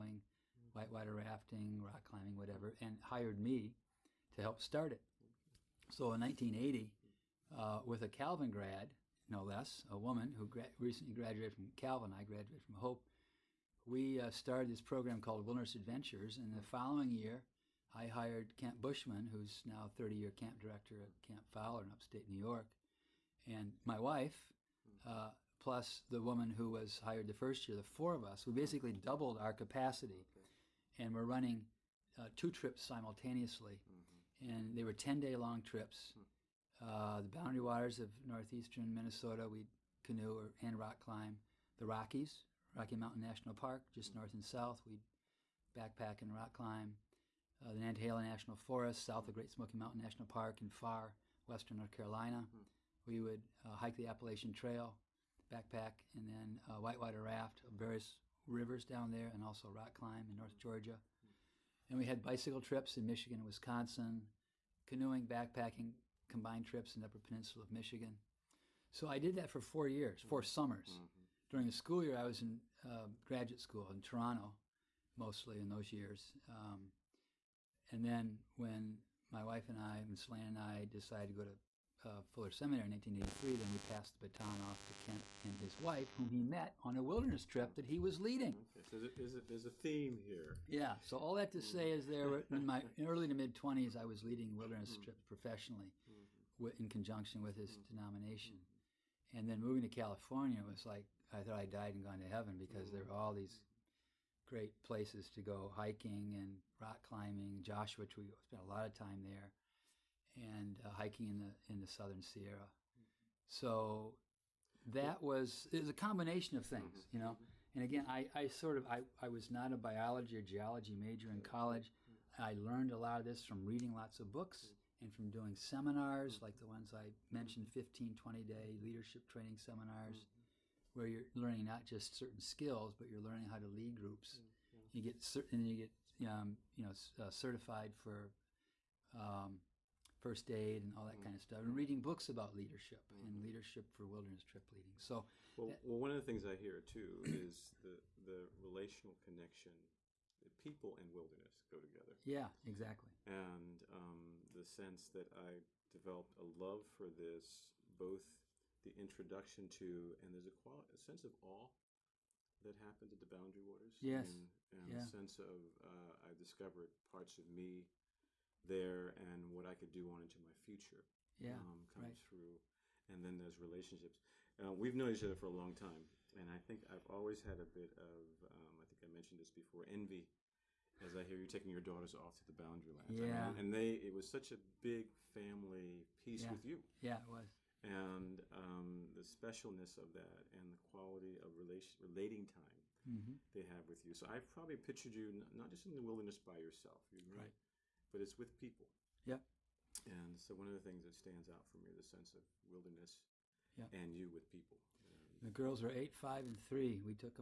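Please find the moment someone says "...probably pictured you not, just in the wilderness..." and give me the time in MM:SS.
03:14.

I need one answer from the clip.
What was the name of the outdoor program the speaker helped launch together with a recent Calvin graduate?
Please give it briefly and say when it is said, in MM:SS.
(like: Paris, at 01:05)
Wilderness Adventures, at 00:15.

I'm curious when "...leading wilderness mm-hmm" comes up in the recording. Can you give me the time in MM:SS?
01:34.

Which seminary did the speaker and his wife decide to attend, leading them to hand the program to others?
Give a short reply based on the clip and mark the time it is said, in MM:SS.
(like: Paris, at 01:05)
Fuller Seminary, at 01:22.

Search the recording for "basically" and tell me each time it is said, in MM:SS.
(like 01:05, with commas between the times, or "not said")
00:28.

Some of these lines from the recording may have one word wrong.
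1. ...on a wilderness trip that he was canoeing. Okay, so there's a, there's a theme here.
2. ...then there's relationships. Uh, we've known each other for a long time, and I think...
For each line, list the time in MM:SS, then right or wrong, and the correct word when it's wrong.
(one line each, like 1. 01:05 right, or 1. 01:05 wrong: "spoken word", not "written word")
1. 01:26 wrong: "leading", not "canoeing"
2. 02:53 right.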